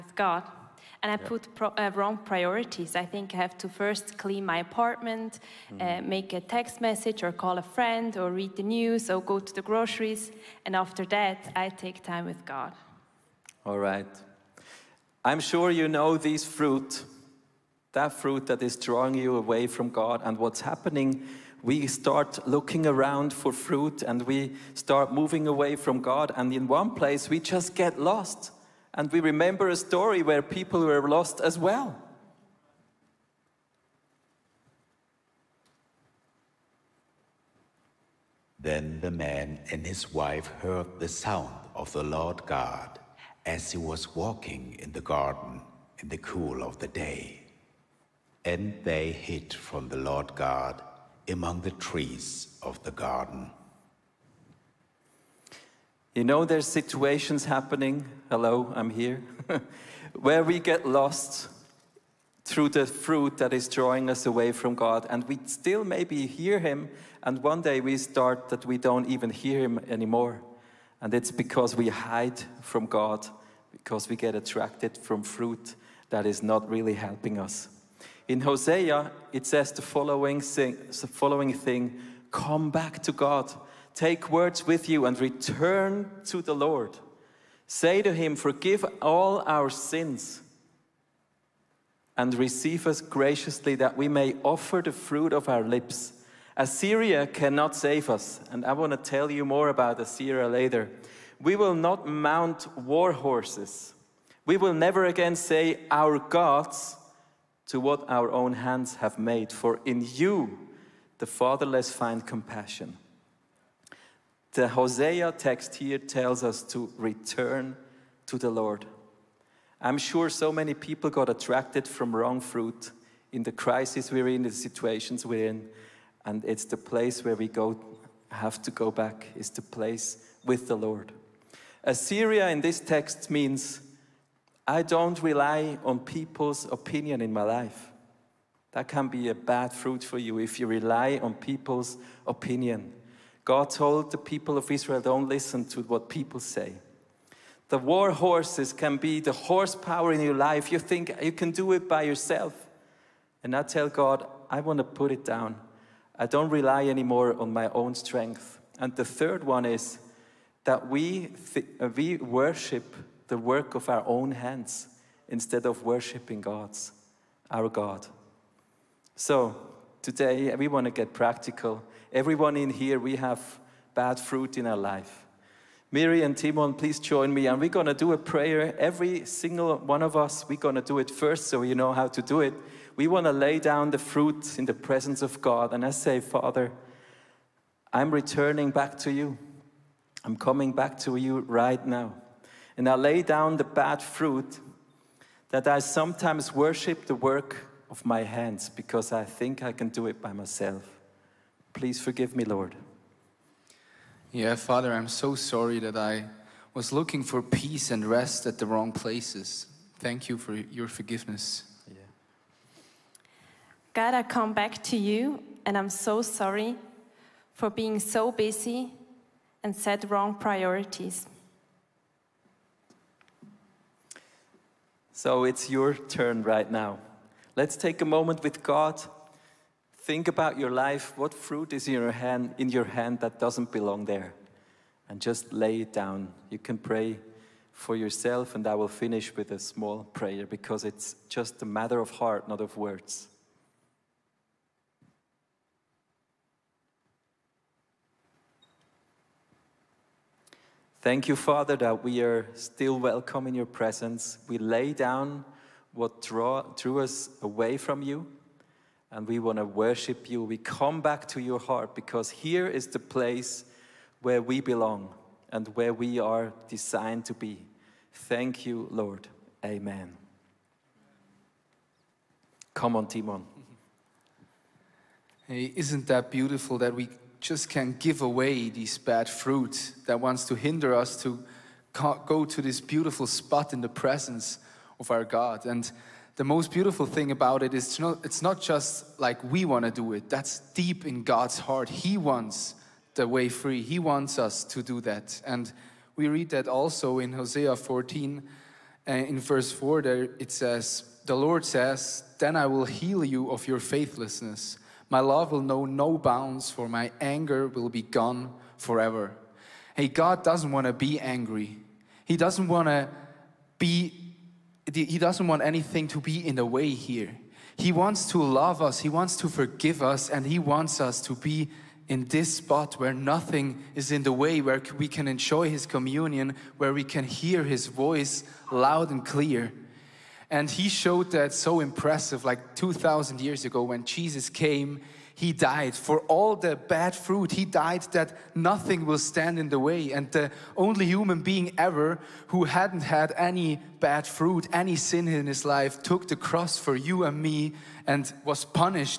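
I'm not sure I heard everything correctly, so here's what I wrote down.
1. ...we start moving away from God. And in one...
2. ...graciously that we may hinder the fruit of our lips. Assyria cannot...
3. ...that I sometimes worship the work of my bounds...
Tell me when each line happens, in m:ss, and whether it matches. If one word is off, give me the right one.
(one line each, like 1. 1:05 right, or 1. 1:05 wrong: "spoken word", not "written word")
1. 0:24 right
2. 1:33 wrong: "offer", not "hinder"
3. 3:15 wrong: "hands", not "bounds".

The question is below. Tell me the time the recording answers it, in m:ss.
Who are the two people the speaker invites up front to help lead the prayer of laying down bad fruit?
2:55.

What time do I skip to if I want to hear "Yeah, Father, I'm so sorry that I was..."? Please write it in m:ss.
3:24.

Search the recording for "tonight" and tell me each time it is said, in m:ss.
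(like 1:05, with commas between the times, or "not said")
not said.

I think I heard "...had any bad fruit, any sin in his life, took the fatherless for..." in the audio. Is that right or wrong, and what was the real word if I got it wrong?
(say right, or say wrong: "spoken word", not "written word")
wrong: "cross", not "fatherless".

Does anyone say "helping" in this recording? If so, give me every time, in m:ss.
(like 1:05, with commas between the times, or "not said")
1:16.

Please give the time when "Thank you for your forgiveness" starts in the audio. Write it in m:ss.
3:29.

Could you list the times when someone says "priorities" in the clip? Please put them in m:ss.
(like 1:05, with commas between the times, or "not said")
0:02, 3:40.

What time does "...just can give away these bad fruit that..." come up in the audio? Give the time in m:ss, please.
4:37.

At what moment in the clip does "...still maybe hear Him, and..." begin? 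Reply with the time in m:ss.
1:05.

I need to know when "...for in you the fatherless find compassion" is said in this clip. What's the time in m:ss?
1:49.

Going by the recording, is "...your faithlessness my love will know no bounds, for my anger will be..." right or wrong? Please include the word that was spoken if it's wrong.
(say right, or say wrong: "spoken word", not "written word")
right.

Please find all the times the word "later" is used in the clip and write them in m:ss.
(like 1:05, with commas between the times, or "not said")
1:40.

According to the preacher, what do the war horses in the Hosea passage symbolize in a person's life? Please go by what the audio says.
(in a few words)
Horsepower.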